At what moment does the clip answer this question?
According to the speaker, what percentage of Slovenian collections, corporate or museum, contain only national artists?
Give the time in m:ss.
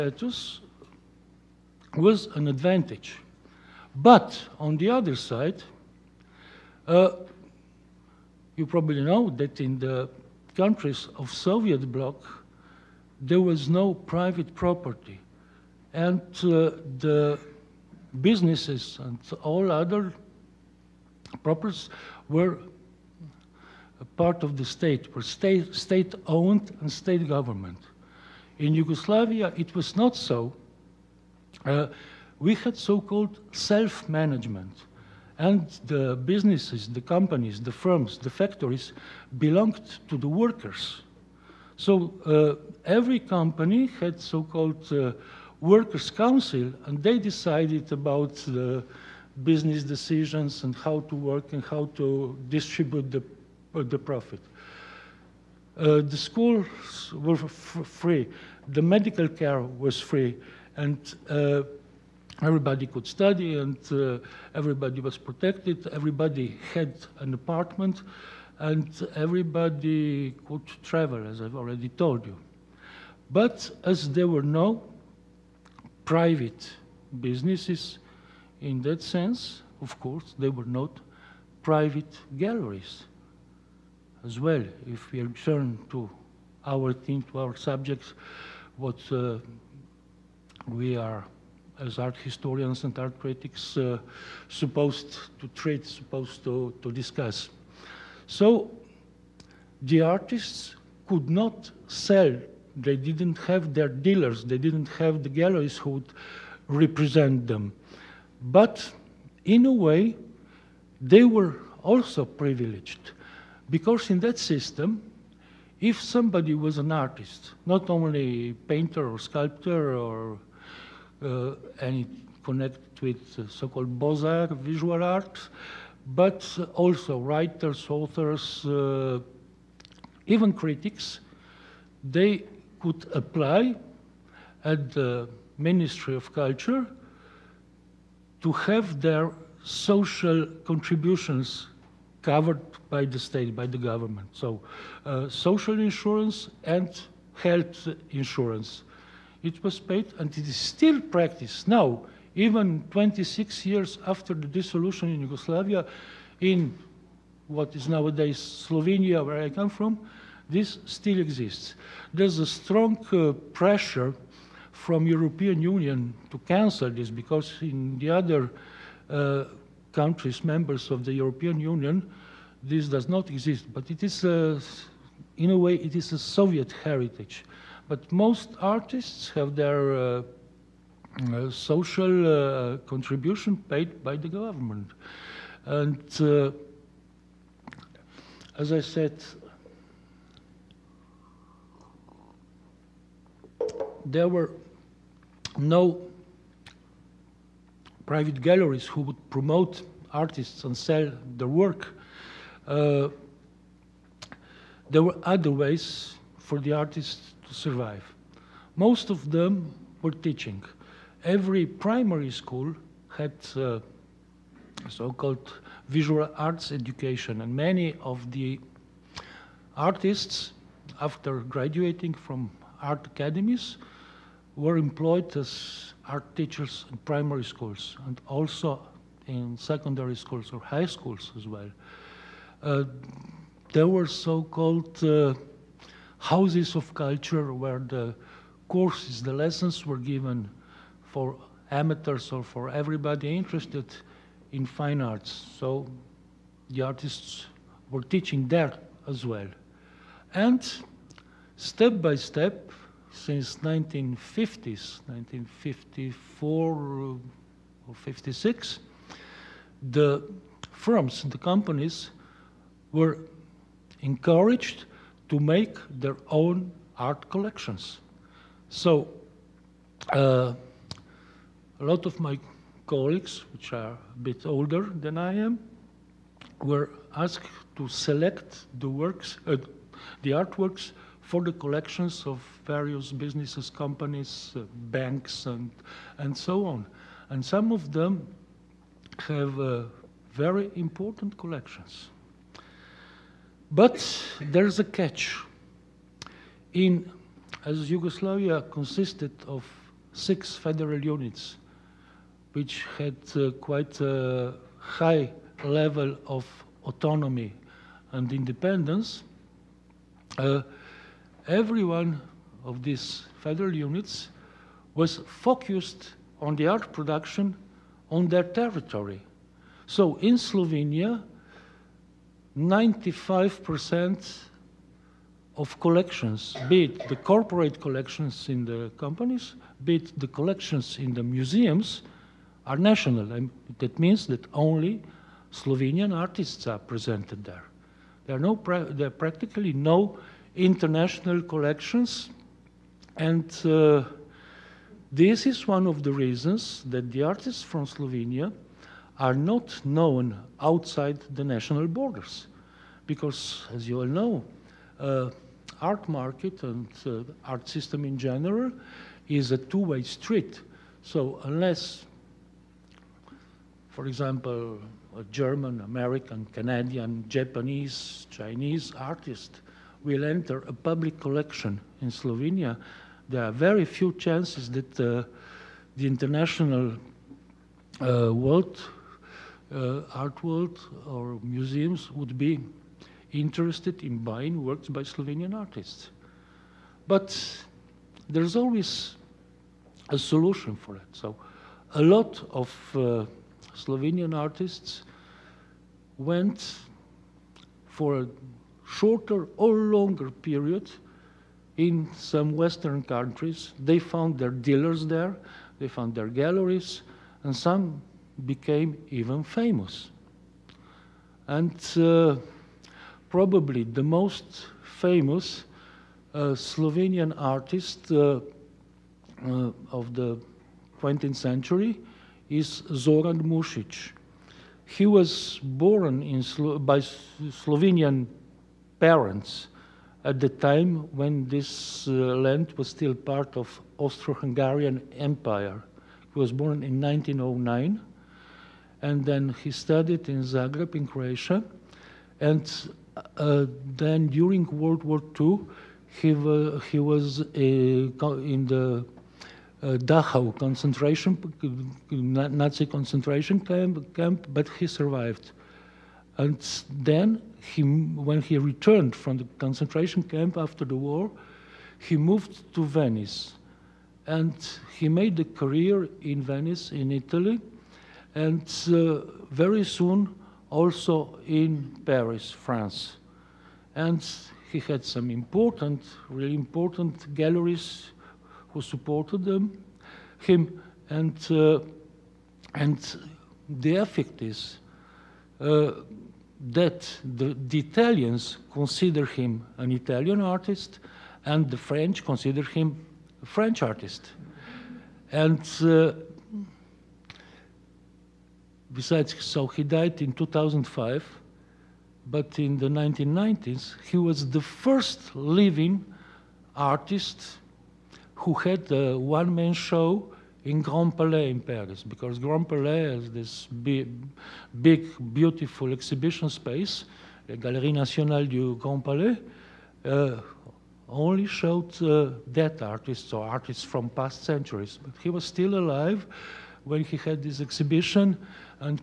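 5:22.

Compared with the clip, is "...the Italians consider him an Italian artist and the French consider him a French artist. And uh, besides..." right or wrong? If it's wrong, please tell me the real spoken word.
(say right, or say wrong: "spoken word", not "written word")
right.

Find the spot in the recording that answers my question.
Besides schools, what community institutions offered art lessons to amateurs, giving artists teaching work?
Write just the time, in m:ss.
3:56.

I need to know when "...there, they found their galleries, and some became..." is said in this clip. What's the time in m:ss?
6:45.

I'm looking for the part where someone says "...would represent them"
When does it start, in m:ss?
1:45.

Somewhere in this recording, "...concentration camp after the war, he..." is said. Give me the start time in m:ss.
7:39.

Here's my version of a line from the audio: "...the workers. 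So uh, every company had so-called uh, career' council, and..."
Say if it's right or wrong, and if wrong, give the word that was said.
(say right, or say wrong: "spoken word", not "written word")
wrong: "workers", not "career".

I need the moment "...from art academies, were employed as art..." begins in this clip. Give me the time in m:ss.
3:42.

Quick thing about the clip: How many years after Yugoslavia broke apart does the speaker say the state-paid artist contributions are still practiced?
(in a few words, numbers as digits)
26.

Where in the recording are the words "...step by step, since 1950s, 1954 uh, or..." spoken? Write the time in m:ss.
4:11.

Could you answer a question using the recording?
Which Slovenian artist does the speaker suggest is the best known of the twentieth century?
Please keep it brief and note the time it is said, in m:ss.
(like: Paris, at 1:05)
Zoran Mušić, at 7:02.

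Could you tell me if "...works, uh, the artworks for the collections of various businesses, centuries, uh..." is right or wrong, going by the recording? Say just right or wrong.
wrong.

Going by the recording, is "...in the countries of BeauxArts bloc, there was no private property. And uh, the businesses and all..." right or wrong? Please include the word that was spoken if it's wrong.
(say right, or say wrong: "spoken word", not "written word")
wrong: "Soviet", not "BeauxArts".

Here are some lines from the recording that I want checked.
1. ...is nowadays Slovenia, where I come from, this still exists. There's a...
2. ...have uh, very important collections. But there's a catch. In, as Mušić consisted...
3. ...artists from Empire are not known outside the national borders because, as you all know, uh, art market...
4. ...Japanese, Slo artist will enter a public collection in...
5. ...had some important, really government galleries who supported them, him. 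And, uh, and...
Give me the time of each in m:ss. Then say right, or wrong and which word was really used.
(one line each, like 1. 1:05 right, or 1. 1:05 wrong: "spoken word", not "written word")
1. 2:37 right
2. 4:49 wrong: "Yugoslavia", not "Mušić"
3. 5:47 wrong: "Slovenia", not "Empire"
4. 6:07 wrong: "Chinese", not "Slo"
5. 7:54 wrong: "important", not "government".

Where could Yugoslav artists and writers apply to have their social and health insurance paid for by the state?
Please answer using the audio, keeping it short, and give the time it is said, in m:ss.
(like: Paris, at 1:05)
Ministry of Culture, at 2:15.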